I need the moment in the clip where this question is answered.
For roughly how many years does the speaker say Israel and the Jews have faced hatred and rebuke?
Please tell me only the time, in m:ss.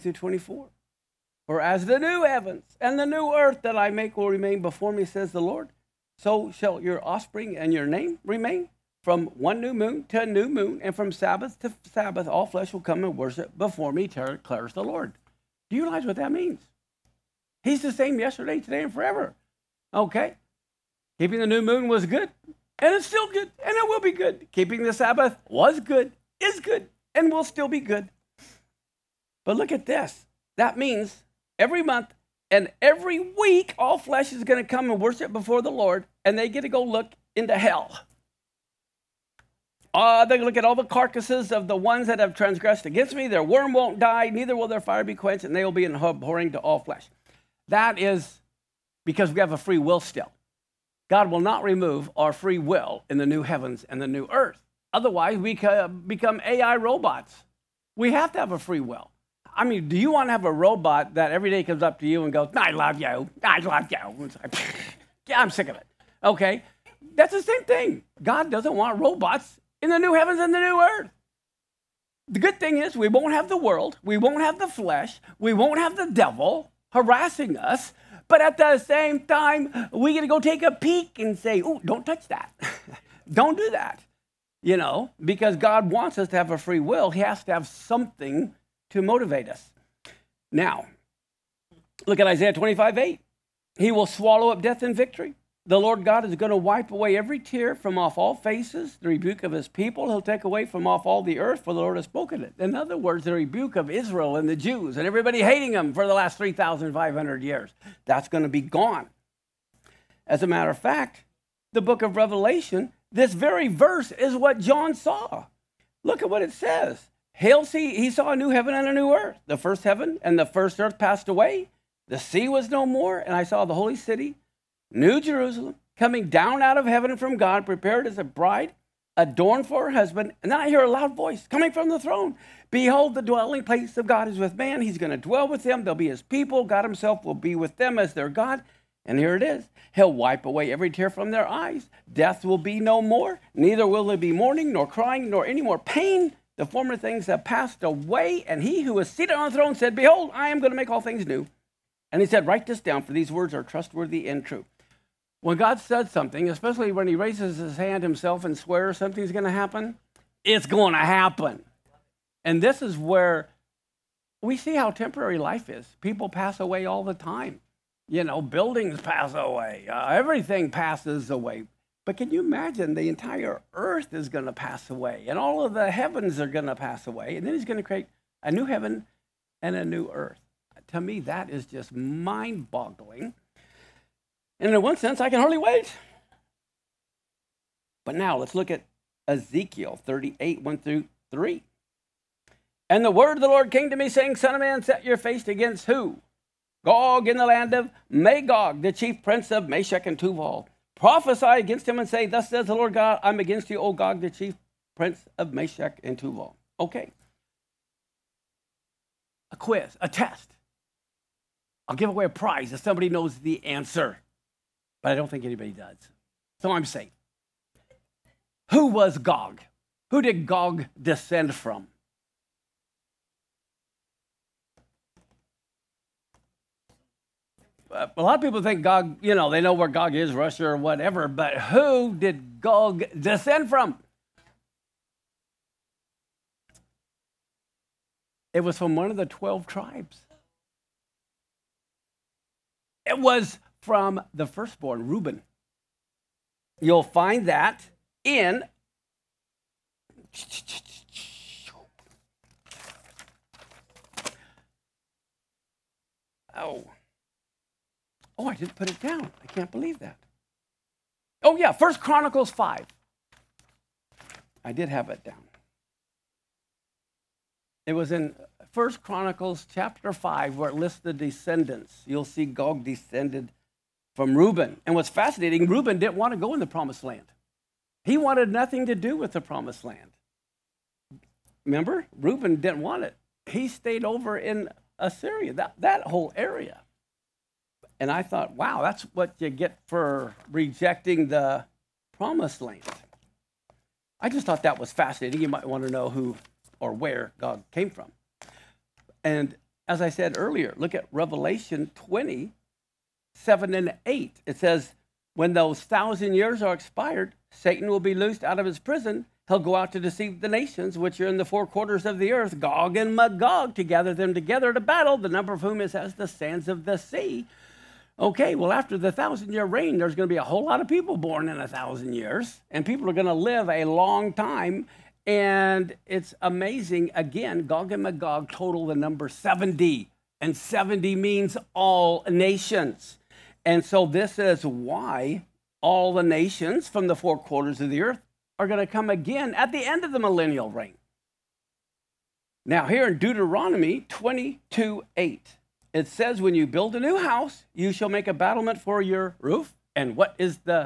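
1:46.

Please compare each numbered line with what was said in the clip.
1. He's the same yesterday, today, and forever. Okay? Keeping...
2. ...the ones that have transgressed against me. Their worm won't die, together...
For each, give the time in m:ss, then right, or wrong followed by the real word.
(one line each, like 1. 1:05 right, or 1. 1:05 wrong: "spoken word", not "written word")
1. 0:17 right
2. 0:41 wrong: "neither", not "together".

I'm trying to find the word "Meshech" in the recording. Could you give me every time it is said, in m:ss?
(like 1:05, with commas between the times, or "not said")
3:19, 3:25.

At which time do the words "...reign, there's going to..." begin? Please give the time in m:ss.
5:19.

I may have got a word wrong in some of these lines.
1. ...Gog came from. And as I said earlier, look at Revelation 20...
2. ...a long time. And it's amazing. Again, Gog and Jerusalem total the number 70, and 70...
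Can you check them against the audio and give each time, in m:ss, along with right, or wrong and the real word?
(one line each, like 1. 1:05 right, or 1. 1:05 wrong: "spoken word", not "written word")
1. 4:57 right
2. 5:23 wrong: "Magog", not "Jerusalem".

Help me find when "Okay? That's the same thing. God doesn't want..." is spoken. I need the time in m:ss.
1:06.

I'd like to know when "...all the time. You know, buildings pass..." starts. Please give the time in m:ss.
2:46.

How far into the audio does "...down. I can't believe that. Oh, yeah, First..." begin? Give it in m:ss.
4:18.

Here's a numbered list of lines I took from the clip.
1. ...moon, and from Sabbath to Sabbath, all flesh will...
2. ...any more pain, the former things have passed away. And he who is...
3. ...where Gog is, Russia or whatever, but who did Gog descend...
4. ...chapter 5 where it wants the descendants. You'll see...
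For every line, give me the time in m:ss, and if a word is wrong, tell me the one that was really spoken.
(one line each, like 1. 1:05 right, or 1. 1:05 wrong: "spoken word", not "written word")
1. 0:10 right
2. 2:25 right
3. 3:49 right
4. 4:29 wrong: "lists", not "wants".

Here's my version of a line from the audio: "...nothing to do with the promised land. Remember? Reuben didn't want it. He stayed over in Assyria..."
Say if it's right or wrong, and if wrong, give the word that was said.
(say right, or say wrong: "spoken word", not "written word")
right.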